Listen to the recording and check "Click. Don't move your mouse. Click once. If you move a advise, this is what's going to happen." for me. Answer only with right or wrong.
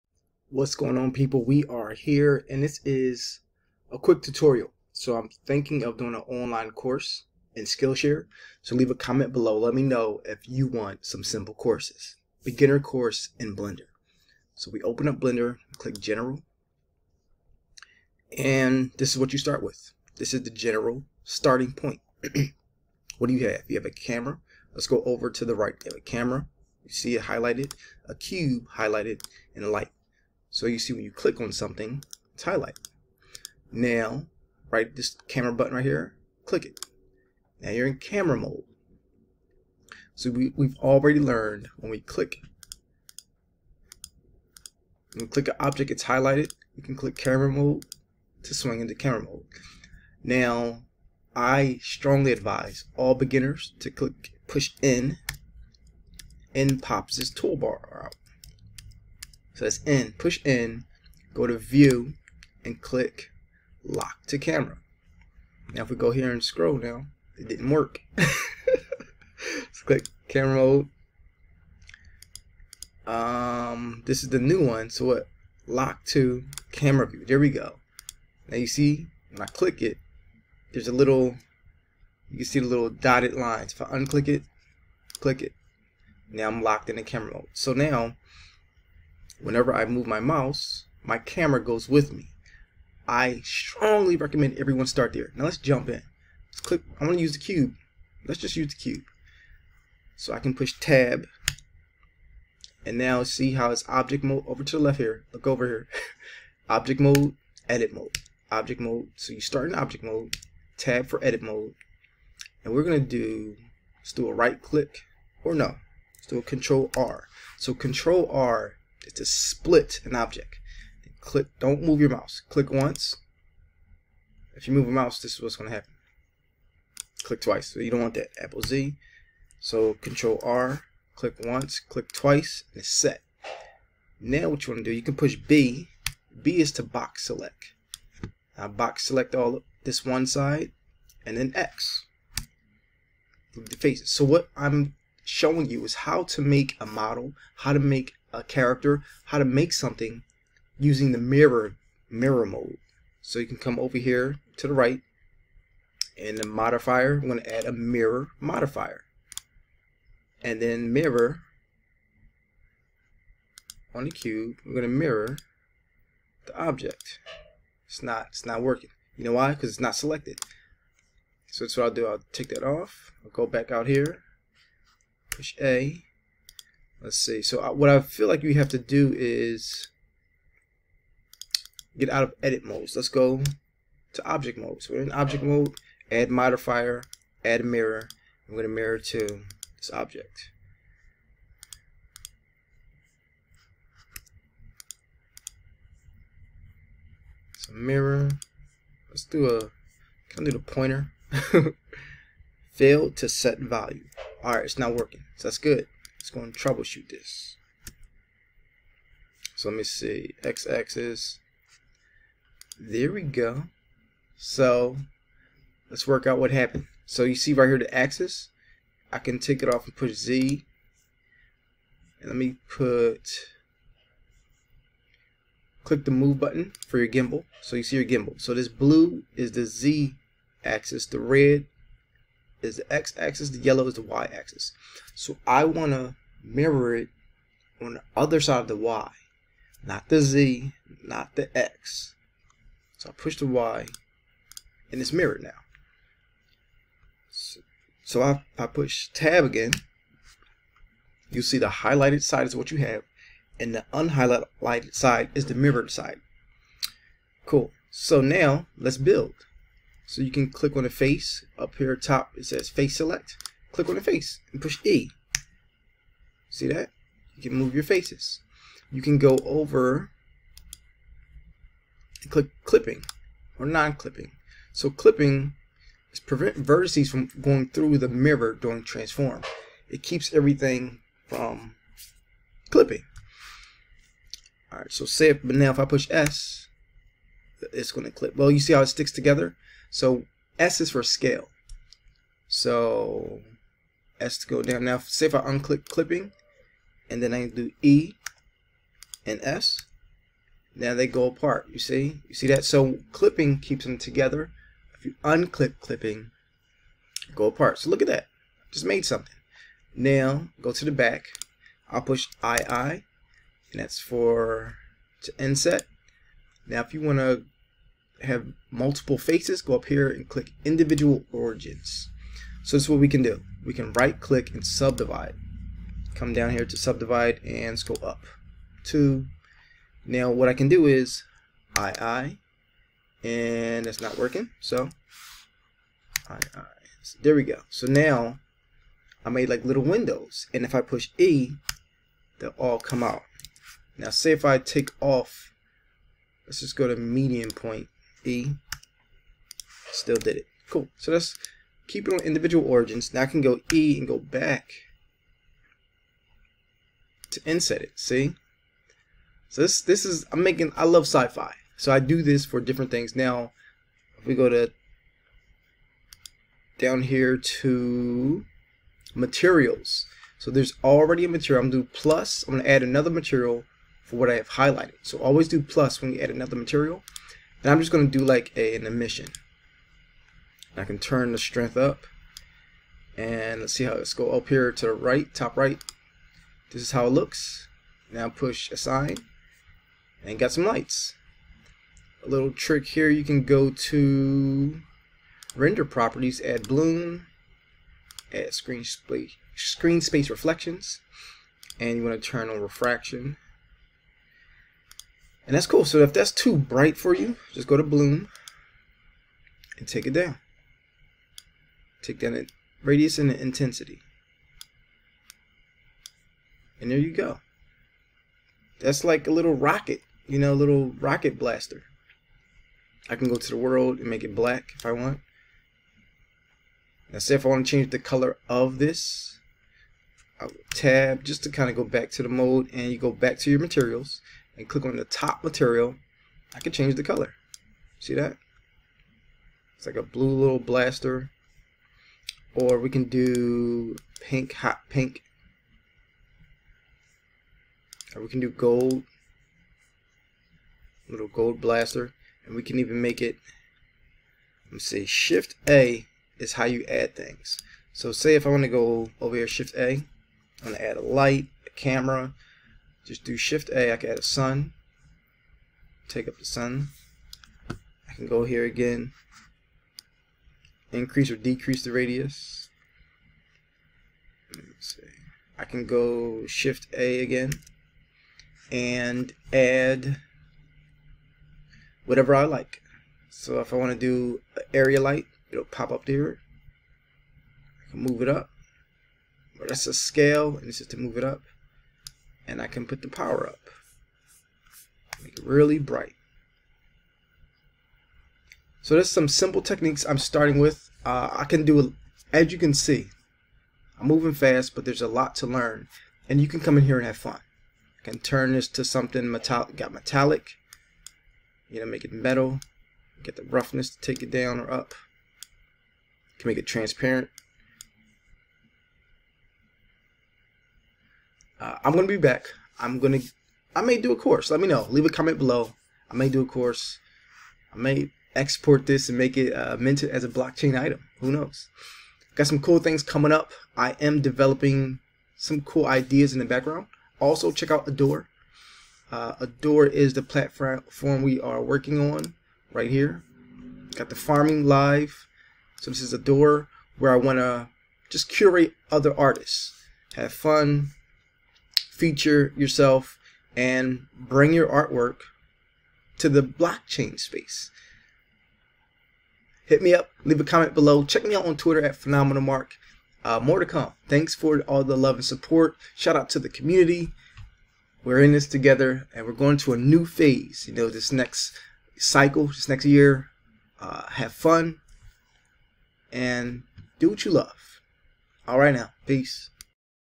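wrong.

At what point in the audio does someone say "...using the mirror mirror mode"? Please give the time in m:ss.
2:30.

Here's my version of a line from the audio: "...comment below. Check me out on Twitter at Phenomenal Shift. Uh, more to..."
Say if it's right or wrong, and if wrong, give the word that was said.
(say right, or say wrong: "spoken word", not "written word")
wrong: "Mark", not "Shift".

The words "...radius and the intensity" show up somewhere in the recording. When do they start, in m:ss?
6:52.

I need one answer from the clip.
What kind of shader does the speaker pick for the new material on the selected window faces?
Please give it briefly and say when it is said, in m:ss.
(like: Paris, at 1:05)
Emission, at 6:18.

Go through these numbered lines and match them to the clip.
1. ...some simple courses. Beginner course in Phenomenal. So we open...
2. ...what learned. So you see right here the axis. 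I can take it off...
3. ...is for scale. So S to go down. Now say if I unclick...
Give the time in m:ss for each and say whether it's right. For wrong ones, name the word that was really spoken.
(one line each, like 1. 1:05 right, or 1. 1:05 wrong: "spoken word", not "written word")
1. 0:11 wrong: "Blender", not "Phenomenal"
2. 3:36 wrong: "happened", not "learned"
3. 4:50 right.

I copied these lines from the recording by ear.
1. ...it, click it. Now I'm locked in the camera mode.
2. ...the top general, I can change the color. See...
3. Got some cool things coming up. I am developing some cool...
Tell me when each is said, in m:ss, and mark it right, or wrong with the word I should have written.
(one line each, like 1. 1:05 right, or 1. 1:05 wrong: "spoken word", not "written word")
1. 1:24 right
2. 7:14 wrong: "material", not "general"
3. 8:52 right.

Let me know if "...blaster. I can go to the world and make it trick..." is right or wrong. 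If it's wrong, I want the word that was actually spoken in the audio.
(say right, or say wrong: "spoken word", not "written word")
wrong: "black", not "trick".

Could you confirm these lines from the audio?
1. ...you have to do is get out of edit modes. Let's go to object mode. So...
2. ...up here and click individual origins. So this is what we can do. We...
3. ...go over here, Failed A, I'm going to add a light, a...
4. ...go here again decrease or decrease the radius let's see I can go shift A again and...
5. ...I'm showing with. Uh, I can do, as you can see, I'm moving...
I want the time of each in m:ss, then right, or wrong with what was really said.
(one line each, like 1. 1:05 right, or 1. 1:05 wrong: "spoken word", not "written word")
1. 2:58 right
2. 5:19 right
3. 7:38 wrong: "Shift", not "Failed"
4. 7:48 wrong: "increase", not "decrease"
5. 8:20 wrong: "starting", not "showing".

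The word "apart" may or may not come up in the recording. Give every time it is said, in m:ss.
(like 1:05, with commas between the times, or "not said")
5:01, 5:07.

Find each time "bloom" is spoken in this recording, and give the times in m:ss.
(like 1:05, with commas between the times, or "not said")
6:36, 6:47.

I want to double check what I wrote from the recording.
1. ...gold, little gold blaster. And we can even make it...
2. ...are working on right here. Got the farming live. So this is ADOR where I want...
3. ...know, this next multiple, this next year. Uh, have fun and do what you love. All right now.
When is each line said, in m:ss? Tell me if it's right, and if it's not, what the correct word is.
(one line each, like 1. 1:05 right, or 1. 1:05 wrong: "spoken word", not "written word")
1. 7:28 right
2. 9:01 right
3. 9:30 wrong: "cycle", not "multiple".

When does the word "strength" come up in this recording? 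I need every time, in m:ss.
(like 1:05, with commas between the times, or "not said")
6:21.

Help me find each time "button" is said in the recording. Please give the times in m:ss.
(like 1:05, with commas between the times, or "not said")
0:35, 3:46.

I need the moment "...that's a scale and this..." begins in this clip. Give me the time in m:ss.
8:09.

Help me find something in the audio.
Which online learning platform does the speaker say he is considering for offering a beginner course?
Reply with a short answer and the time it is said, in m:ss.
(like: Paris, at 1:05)
Skillshare, at 0:07.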